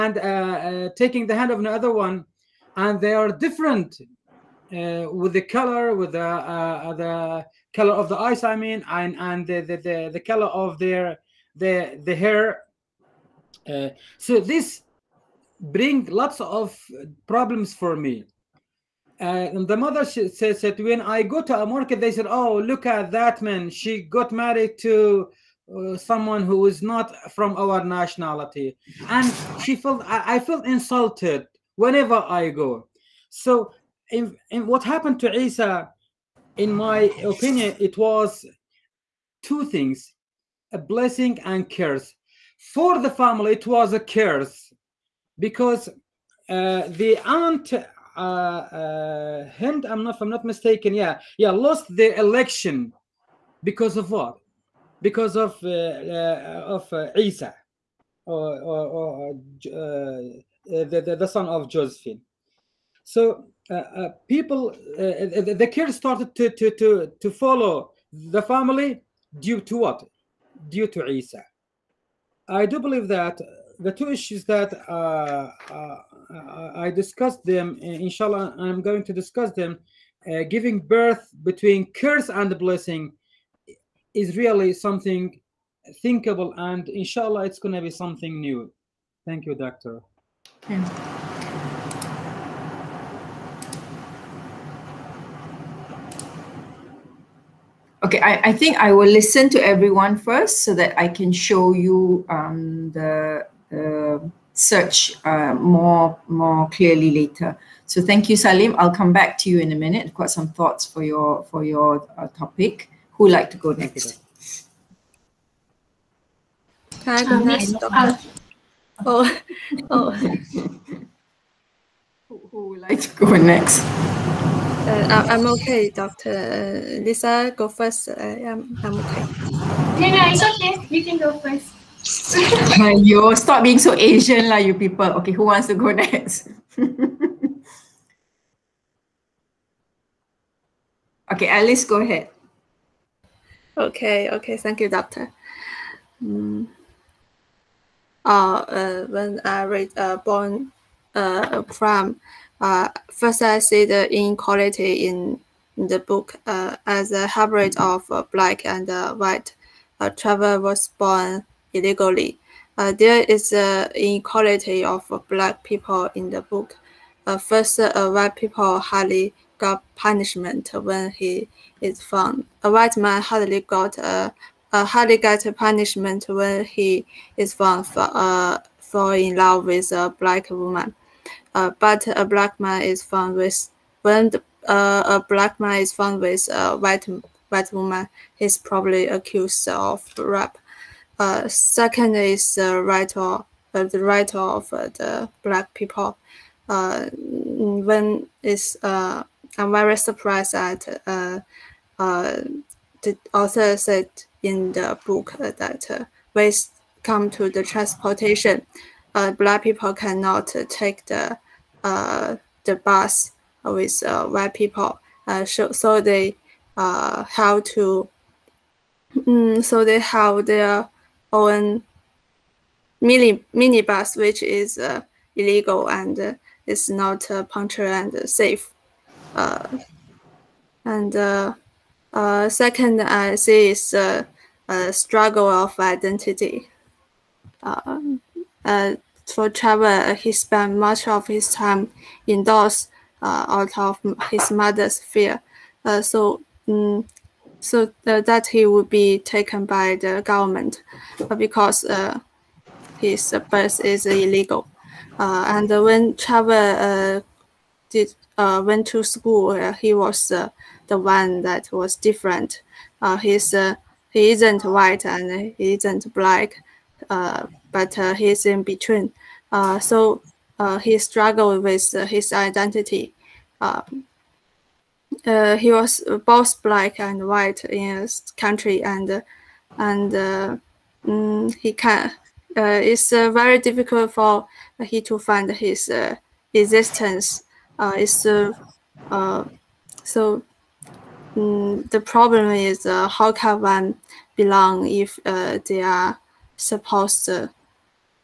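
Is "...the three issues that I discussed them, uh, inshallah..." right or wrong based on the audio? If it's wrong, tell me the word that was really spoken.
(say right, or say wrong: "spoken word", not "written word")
wrong: "two", not "three".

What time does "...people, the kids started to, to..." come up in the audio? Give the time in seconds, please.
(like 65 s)
64 s.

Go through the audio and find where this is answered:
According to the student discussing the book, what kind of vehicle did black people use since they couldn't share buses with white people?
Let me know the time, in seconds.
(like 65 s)
223 s.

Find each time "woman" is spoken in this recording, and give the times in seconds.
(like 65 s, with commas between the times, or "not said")
180 s, 187 s.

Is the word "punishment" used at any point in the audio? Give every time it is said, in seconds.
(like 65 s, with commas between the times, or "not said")
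169 s, 175 s.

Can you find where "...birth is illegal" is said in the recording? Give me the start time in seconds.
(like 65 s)
253 s.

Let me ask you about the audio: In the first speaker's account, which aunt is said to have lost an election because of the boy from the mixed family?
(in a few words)
Hind.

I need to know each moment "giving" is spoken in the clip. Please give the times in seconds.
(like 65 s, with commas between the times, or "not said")
80 s.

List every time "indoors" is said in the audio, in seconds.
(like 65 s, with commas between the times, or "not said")
242 s.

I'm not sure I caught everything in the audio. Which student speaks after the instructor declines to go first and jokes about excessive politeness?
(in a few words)
Alice.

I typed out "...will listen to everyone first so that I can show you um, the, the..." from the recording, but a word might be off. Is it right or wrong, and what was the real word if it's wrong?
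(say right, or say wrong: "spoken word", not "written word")
right.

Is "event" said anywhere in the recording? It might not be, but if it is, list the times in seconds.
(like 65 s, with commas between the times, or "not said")
not said.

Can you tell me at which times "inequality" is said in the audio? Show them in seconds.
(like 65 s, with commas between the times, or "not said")
154 s, 163 s.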